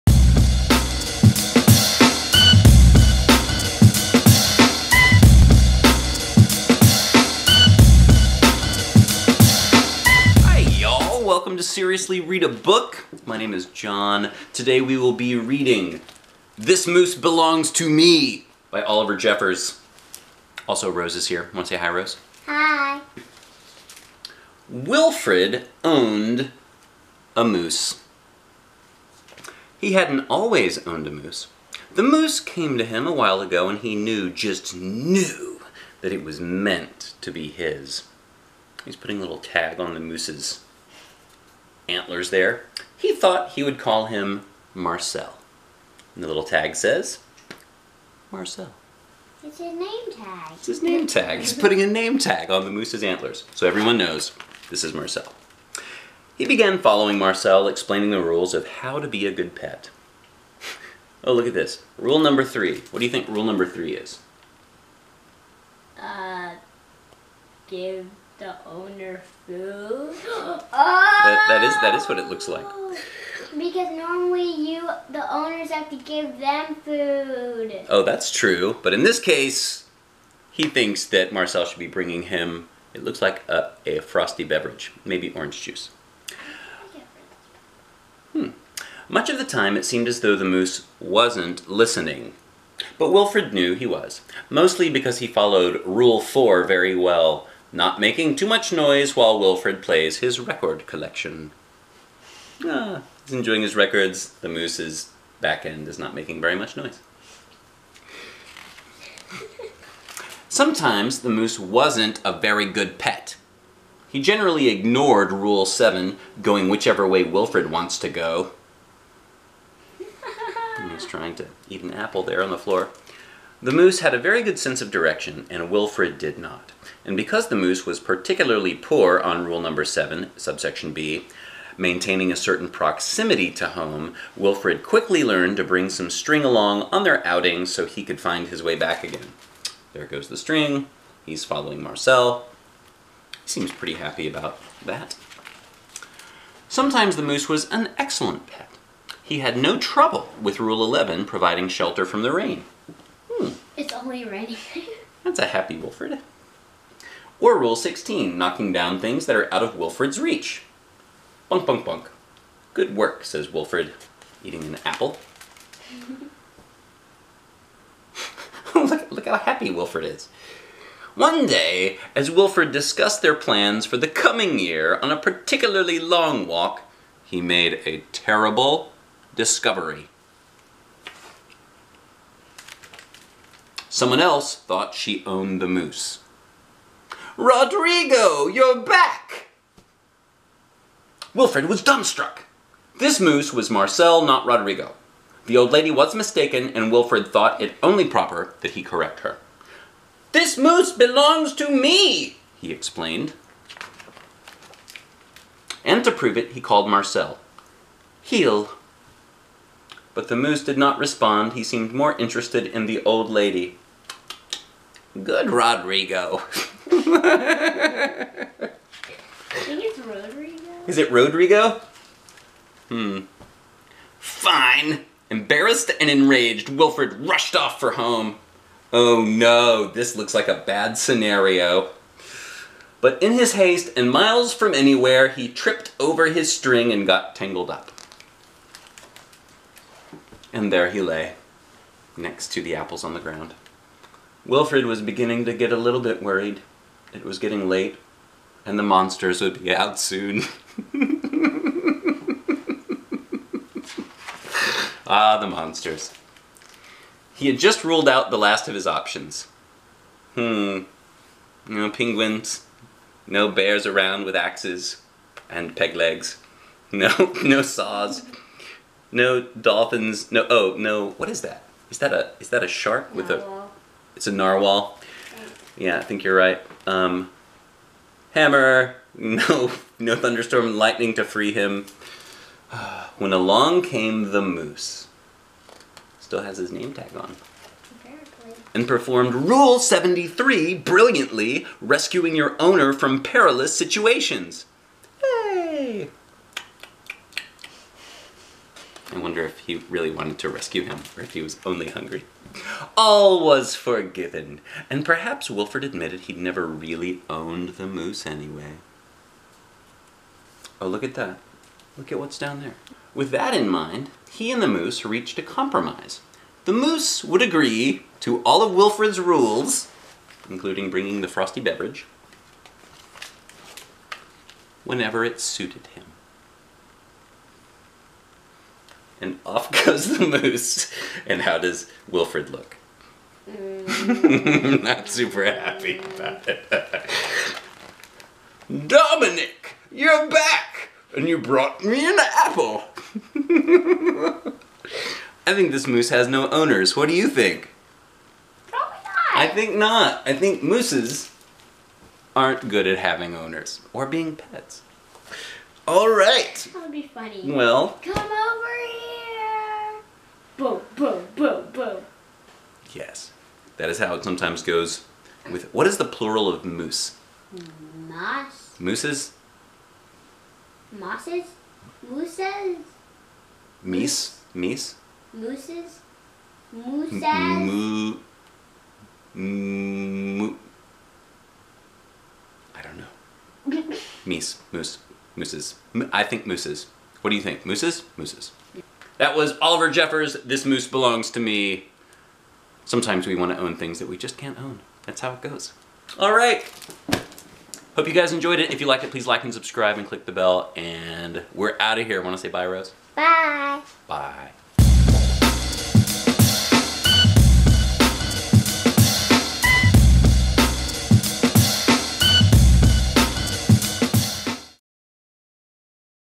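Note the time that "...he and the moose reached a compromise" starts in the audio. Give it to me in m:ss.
5:14.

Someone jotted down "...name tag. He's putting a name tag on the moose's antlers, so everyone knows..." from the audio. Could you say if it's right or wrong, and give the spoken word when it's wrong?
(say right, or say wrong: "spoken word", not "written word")
right.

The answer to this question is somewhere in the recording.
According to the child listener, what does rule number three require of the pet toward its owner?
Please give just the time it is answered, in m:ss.
1:07.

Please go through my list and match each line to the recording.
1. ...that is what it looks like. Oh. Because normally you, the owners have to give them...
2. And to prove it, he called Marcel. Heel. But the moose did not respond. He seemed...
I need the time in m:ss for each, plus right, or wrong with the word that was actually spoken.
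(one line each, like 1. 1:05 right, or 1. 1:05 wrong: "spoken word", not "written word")
1. 1:11 right
2. 3:25 right.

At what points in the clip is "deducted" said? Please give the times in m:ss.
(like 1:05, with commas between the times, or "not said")
not said.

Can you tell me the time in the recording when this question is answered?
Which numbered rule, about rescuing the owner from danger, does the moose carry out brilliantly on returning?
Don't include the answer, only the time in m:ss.
4:49.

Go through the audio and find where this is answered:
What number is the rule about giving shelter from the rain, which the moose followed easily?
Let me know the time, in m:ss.
2:30.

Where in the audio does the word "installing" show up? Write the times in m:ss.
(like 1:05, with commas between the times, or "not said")
not said.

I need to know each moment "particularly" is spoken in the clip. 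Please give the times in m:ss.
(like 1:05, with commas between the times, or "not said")
2:07, 2:55.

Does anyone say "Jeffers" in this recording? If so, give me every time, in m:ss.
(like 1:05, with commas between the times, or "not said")
0:19, 6:29.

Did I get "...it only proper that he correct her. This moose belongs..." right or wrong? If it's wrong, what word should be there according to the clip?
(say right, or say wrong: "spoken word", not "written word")
right.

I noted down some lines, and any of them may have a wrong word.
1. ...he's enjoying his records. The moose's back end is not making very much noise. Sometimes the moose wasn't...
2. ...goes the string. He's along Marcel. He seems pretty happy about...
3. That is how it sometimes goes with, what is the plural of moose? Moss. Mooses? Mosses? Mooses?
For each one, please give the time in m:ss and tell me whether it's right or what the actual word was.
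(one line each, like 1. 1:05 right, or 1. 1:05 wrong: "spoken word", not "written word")
1. 1:43 right
2. 2:20 wrong: "following", not "along"
3. 6:03 right.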